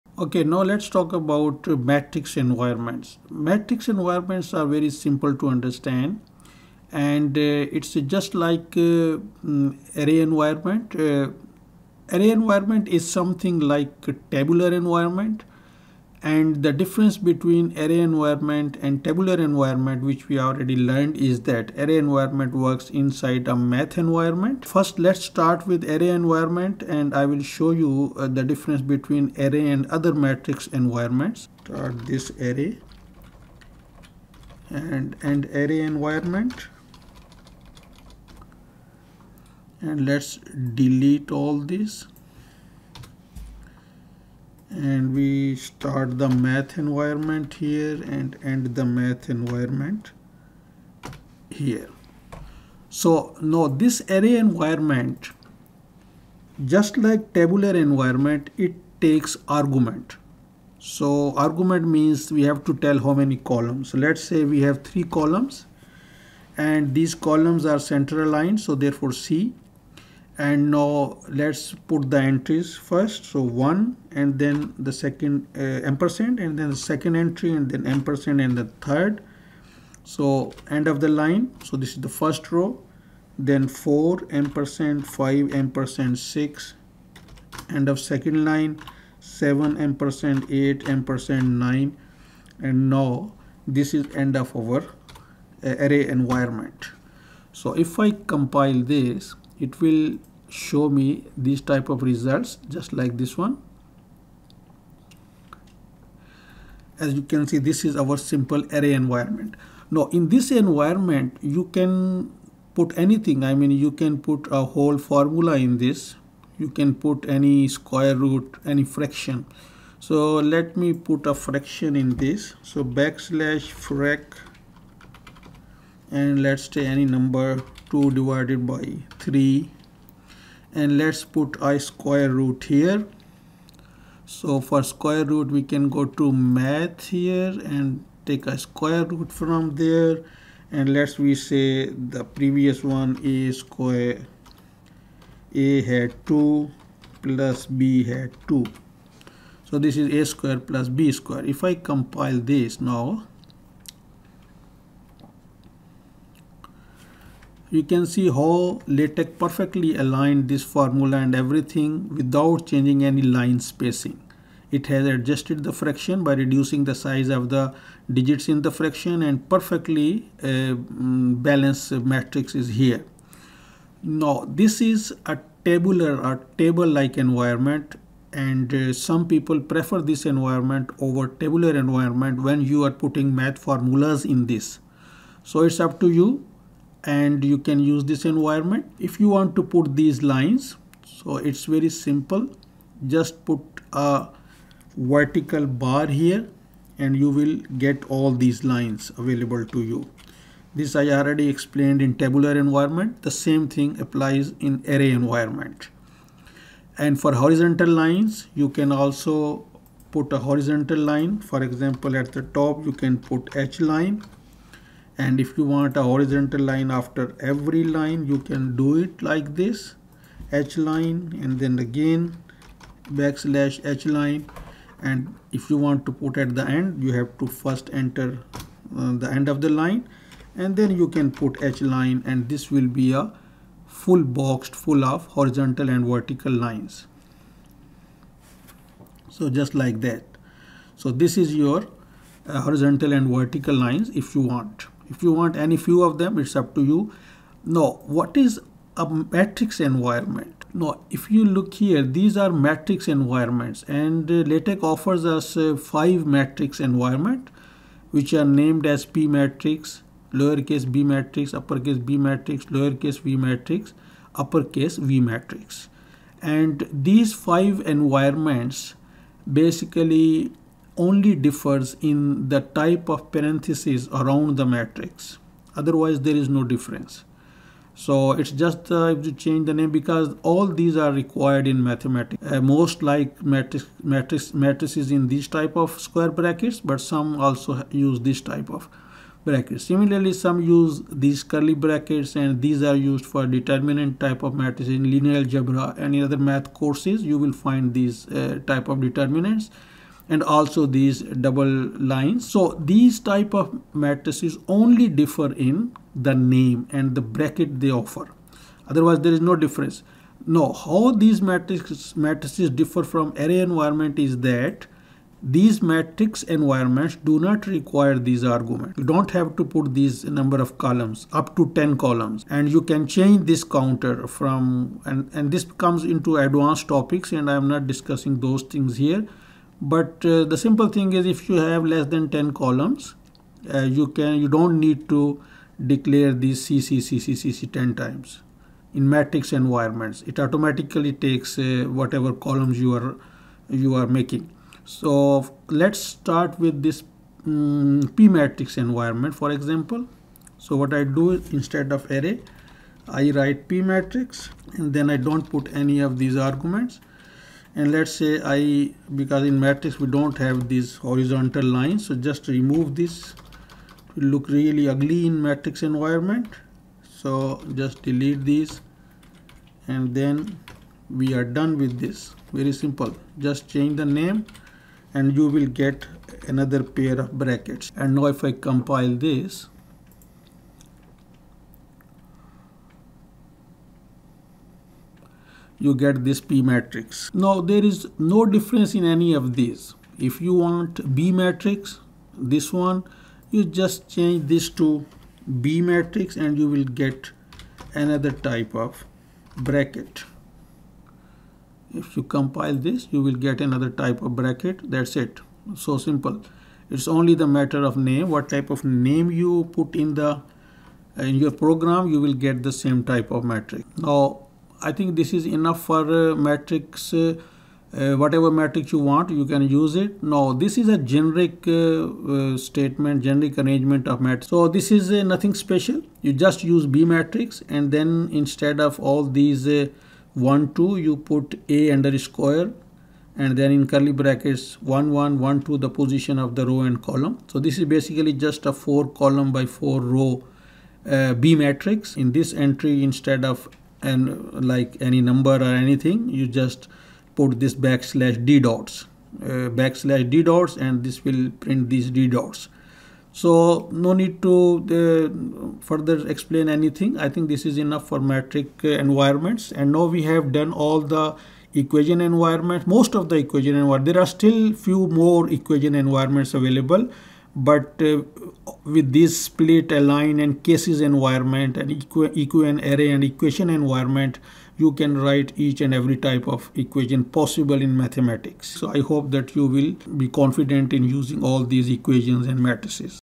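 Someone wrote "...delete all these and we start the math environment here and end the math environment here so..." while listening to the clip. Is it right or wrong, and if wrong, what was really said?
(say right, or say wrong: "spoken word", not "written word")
right.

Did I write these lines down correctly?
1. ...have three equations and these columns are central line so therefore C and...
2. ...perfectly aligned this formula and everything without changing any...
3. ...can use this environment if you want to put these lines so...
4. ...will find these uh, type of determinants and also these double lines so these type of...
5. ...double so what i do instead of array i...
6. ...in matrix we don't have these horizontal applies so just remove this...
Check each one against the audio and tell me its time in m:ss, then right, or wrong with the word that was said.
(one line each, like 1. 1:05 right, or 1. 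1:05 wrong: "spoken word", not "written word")
1. 1:04 wrong: "columns", not "equations"
2. 2:39 right
3. 3:07 right
4. 4:57 right
5. 5:49 wrong: "example", not "double"
6. 5:59 wrong: "lines", not "applies".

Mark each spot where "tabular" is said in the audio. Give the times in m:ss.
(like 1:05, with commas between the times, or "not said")
0:14, 0:19, 0:57, 2:55, 3:01, 3:22.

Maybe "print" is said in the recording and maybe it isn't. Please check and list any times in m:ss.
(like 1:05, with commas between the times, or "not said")
7:31.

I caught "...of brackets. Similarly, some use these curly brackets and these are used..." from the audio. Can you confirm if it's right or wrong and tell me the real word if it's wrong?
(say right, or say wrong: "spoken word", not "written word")
right.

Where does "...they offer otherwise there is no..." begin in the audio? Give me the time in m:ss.
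5:07.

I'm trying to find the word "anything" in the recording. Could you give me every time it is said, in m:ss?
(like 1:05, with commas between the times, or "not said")
1:53, 7:25, 7:36.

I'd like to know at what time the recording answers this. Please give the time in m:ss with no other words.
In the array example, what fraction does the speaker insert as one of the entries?
2:07.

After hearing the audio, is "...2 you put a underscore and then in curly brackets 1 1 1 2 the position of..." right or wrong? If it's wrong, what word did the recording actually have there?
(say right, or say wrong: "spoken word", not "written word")
right.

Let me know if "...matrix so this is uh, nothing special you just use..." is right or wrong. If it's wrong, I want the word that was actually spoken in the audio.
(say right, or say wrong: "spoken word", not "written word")
right.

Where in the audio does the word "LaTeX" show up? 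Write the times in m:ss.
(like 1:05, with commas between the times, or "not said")
2:38, 4:14.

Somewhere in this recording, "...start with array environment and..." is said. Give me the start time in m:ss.
0:25.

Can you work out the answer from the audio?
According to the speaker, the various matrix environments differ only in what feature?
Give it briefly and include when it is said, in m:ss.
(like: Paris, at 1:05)
type of parentheses, at 4:32.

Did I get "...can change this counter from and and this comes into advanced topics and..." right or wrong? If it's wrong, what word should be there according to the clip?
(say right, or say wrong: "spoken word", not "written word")
right.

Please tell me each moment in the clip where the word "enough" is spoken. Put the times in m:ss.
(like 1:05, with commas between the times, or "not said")
6:55, 7:37.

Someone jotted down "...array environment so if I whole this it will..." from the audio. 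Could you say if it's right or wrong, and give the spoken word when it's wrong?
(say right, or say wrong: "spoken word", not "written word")
wrong: "compile", not "whole".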